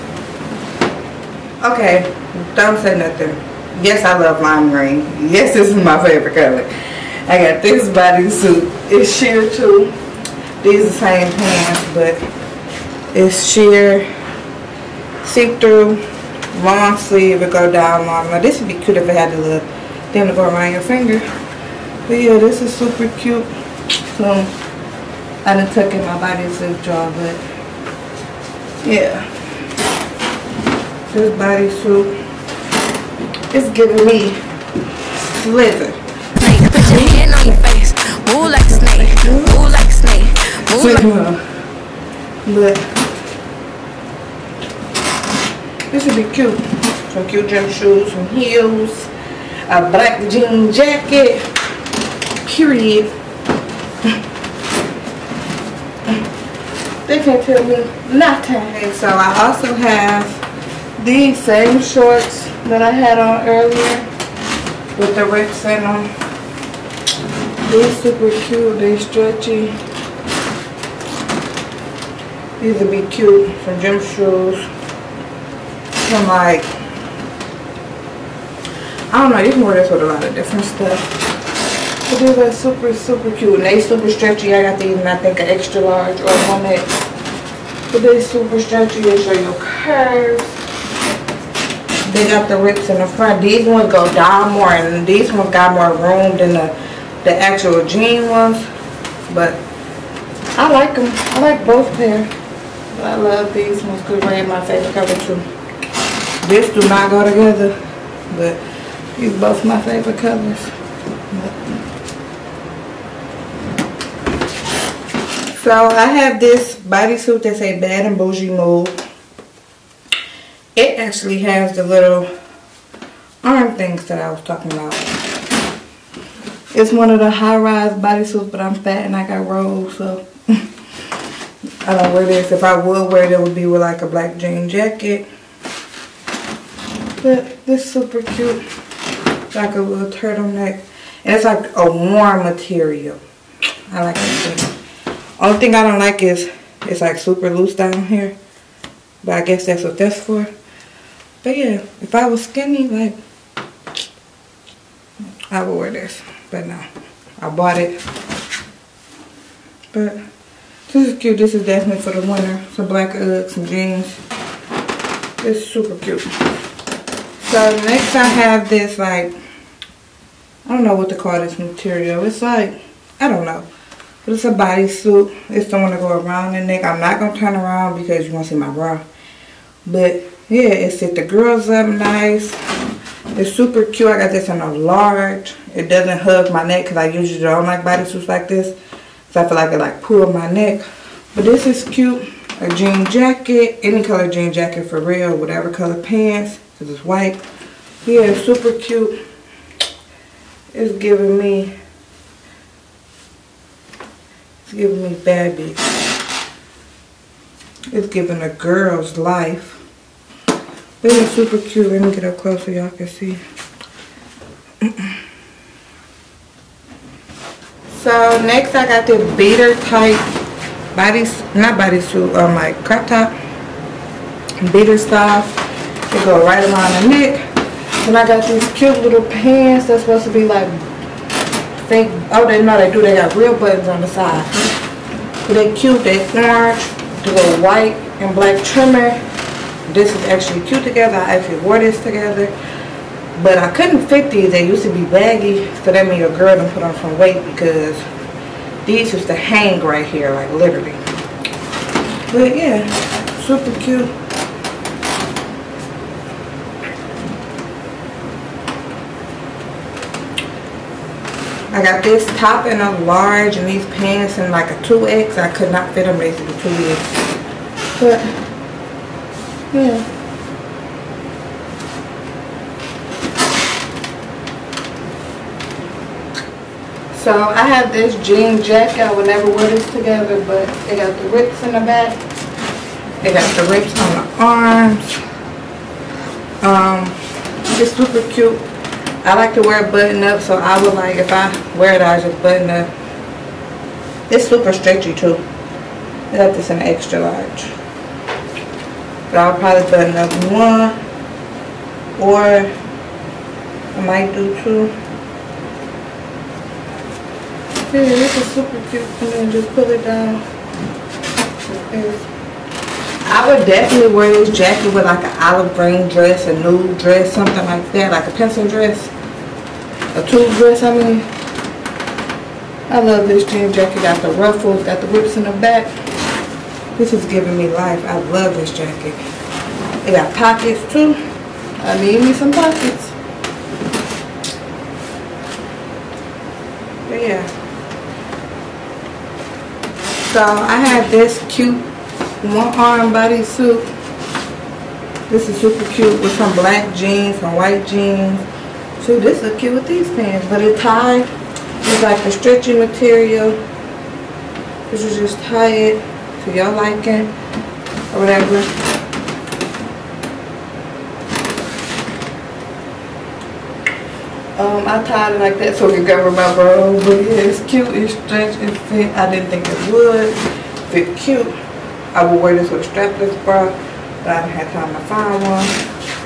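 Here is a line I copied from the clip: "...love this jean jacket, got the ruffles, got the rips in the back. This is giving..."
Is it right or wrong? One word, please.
right.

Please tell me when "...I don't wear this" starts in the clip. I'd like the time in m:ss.
2:11.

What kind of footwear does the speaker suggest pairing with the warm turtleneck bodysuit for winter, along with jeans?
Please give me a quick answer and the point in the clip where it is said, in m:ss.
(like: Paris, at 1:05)
black Uggs, at 2:42.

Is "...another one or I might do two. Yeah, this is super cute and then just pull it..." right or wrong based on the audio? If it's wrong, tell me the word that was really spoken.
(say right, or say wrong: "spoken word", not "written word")
right.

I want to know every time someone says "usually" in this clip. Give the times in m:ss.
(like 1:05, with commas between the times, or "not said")
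3:07.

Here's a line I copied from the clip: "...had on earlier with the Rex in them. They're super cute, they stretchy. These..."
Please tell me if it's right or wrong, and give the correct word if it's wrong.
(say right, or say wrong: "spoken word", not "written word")
right.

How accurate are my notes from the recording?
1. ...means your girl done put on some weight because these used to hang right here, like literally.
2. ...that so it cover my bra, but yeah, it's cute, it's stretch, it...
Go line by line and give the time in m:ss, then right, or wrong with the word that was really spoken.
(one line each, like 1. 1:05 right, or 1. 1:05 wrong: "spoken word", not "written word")
1. 4:06 right
2. 6:05 right.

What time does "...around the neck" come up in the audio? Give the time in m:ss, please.
2:56.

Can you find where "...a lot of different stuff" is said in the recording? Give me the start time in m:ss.
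1:20.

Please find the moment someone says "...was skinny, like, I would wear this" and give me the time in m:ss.
2:32.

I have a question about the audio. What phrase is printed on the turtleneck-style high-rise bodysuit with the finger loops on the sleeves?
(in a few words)
Bad and Bougie Mode.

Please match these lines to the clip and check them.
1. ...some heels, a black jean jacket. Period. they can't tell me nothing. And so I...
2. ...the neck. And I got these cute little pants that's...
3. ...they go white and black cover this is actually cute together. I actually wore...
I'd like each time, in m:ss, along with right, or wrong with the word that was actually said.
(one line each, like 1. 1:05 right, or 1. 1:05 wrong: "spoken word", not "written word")
1. 0:48 right
2. 3:47 right
3. 3:57 wrong: "trimmer", not "cover".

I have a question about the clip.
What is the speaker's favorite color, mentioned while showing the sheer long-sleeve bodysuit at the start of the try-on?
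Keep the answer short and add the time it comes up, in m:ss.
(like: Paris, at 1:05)
lime green, at 0:04.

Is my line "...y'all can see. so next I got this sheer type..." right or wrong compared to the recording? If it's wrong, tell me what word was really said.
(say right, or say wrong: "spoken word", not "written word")
wrong: "beater", not "sheer".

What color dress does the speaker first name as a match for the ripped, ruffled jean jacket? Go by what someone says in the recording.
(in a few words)
olive green.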